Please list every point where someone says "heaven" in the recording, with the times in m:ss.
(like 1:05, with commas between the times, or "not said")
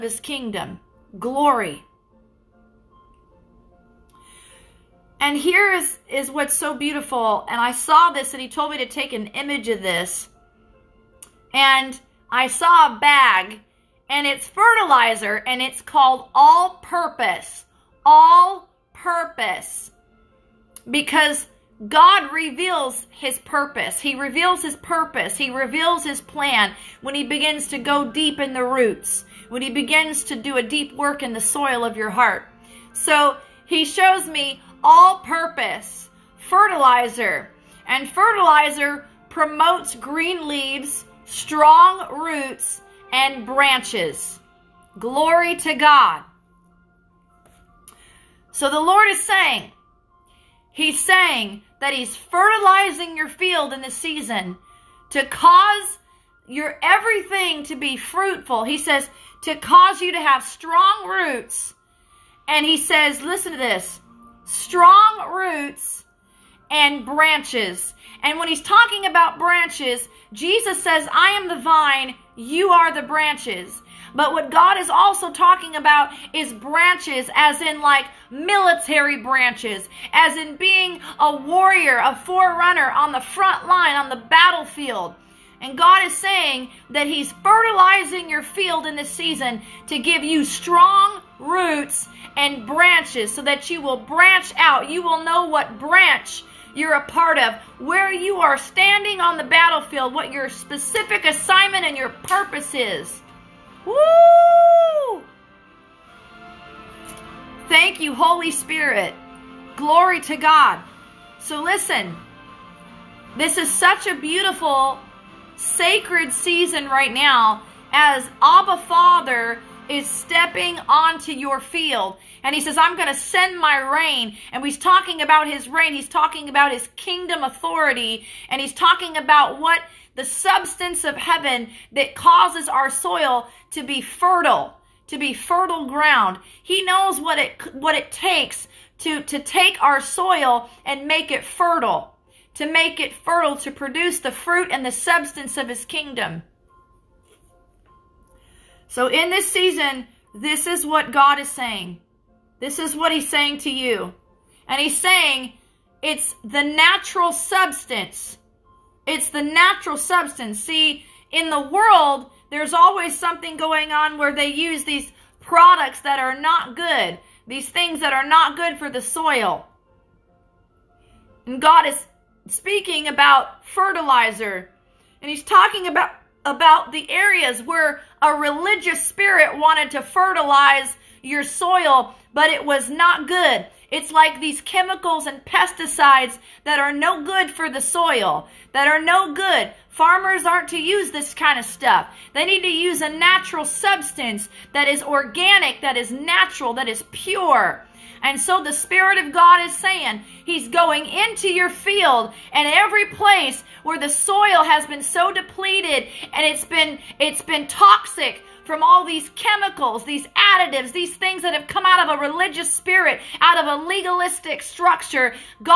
2:11.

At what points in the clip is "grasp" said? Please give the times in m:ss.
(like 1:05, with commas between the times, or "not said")
not said.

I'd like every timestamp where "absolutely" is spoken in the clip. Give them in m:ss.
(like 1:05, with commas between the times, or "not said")
not said.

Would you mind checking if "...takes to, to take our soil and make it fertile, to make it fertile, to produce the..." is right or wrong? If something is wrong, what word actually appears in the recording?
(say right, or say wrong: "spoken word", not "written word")
right.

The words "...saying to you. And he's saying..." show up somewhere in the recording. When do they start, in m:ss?
2:33.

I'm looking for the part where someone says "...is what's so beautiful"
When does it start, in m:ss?
0:06.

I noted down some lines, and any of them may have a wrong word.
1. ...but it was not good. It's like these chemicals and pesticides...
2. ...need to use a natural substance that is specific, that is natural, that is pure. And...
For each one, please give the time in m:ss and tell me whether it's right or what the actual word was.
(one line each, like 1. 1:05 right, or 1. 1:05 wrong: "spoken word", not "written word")
1. 3:02 right
2. 3:12 wrong: "organic", not "specific".